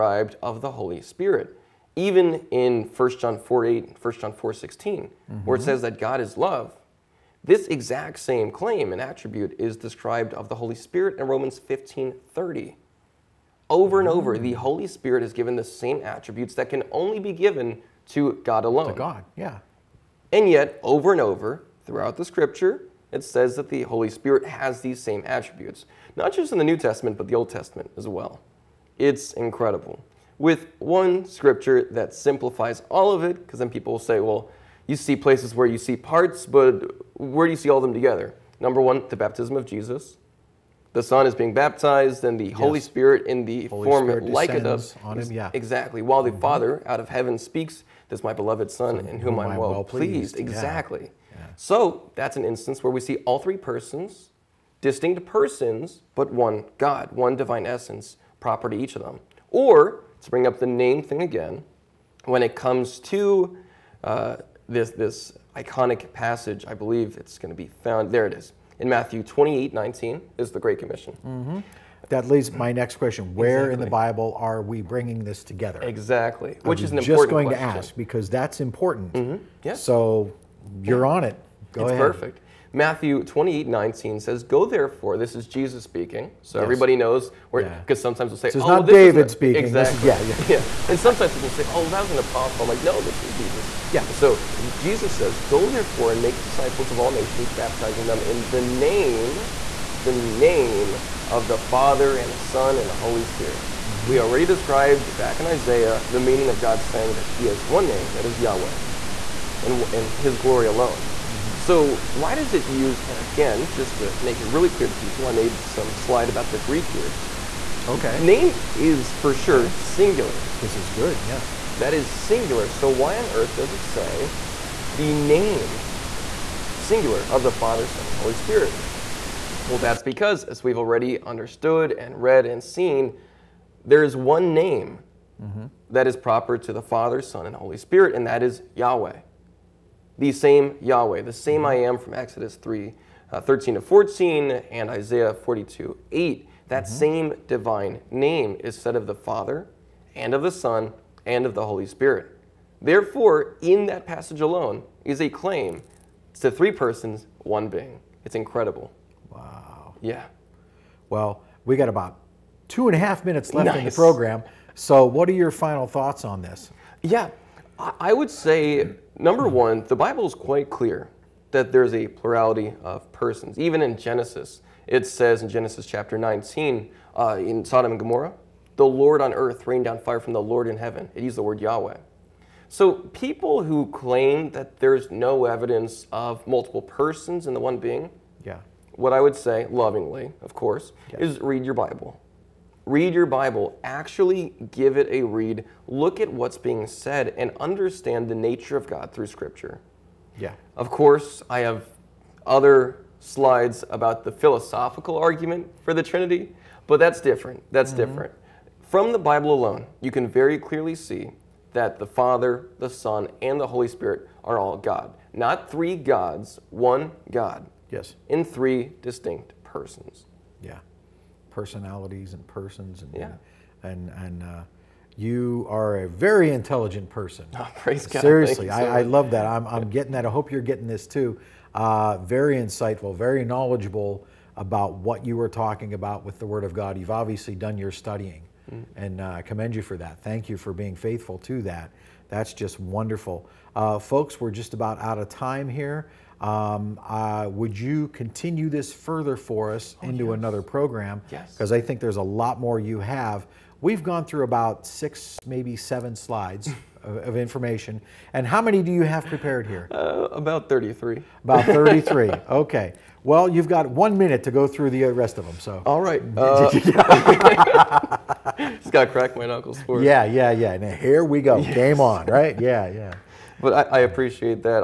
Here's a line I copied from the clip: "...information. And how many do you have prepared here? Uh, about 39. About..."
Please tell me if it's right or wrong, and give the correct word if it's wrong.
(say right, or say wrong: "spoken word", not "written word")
wrong: "33", not "39".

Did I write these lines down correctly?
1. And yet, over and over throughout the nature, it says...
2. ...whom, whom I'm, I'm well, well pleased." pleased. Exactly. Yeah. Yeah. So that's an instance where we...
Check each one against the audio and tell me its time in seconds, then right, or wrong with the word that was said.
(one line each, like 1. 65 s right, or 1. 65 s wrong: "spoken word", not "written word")
1. 20 s wrong: "scripture", not "nature"
2. 49 s right.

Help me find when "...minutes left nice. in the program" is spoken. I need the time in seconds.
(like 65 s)
163 s.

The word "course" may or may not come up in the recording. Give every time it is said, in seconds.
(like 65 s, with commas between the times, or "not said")
190 s, 200 s.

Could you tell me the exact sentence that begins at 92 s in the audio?
I'm like, No, this was Jesus.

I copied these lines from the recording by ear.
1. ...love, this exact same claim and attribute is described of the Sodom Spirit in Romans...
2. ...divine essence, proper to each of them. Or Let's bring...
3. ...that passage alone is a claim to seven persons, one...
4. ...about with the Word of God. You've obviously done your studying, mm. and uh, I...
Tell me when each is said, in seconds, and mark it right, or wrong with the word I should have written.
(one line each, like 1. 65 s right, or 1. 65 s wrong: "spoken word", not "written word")
1. 6 s wrong: "Holy", not "Sodom"
2. 57 s right
3. 153 s wrong: "three", not "seven"
4. 235 s right.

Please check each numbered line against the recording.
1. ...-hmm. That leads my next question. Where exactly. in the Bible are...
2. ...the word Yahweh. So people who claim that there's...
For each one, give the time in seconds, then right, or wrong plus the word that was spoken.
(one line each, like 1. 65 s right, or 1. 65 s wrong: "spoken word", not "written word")
1. 71 s right
2. 181 s right.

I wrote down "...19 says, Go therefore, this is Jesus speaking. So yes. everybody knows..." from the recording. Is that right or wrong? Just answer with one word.
right.